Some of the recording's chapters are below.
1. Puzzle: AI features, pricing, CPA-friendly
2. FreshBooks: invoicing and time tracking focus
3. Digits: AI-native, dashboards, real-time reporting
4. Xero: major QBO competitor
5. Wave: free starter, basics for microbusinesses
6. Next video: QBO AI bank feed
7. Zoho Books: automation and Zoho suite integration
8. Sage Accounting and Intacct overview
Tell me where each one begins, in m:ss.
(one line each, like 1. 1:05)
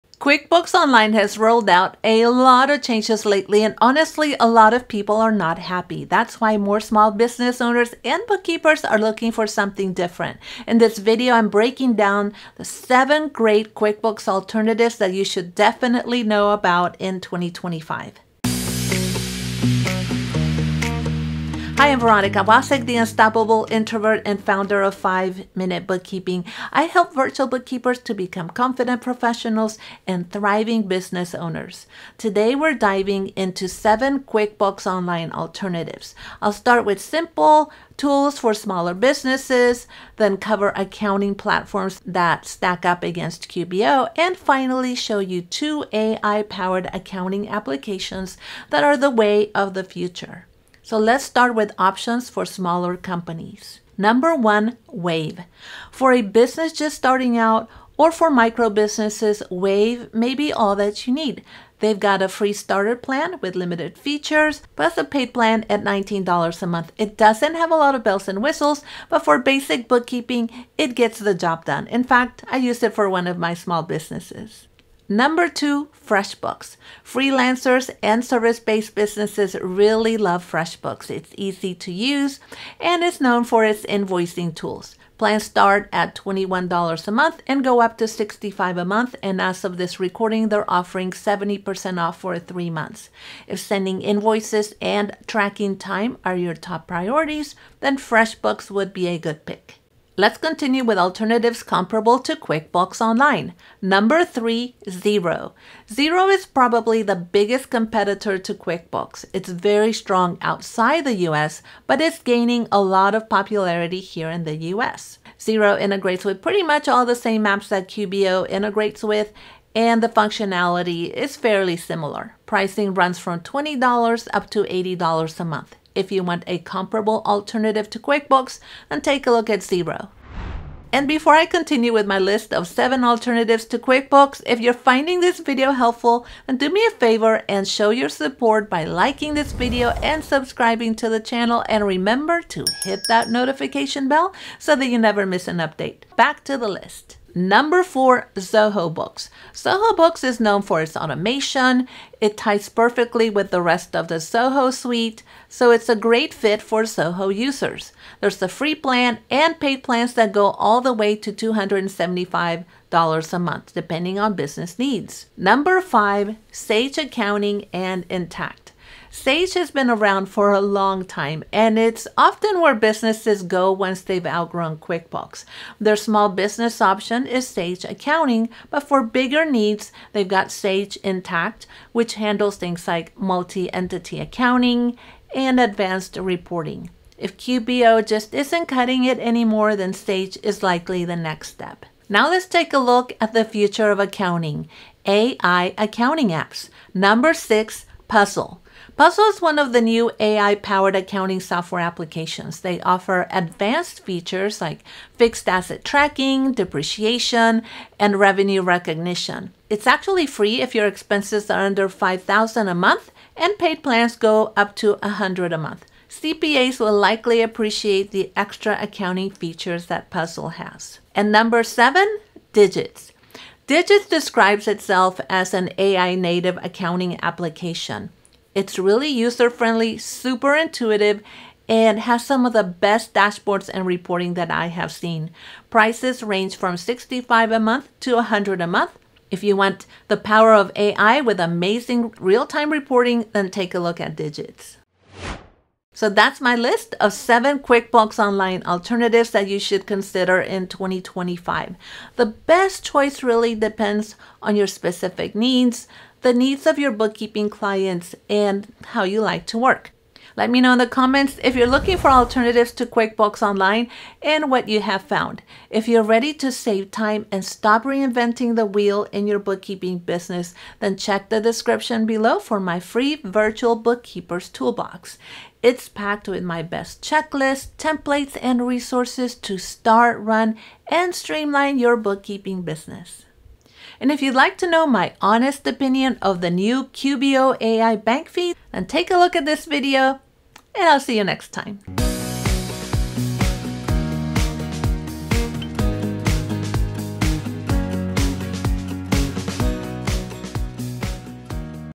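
1. 3:16
2. 1:14
3. 3:41
4. 1:44
5. 0:53
6. 4:43
7. 2:27
8. 2:45.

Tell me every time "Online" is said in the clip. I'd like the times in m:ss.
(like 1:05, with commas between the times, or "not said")
0:00, 0:34, 1:43, 4:08, 4:23.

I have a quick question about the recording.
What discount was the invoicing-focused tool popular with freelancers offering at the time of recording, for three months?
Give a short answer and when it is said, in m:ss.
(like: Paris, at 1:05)
70% off, at 1:31.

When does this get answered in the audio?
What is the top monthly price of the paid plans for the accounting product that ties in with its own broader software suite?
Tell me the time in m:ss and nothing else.
2:41.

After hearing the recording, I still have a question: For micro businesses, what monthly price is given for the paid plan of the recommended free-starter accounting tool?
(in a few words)
$19.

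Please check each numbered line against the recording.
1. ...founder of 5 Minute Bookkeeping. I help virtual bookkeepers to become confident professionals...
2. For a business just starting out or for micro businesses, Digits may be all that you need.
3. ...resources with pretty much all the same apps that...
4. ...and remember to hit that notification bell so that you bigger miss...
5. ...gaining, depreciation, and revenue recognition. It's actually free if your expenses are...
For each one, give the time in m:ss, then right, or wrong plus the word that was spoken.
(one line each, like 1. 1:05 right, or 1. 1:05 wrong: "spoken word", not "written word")
1. 0:24 right
2. 0:55 wrong: "Wave", not "Digits"
3. 1:55 wrong: "integrates", not "resources"
4. 2:21 wrong: "never", not "bigger"
5. 3:25 wrong: "tracking", not "gaining".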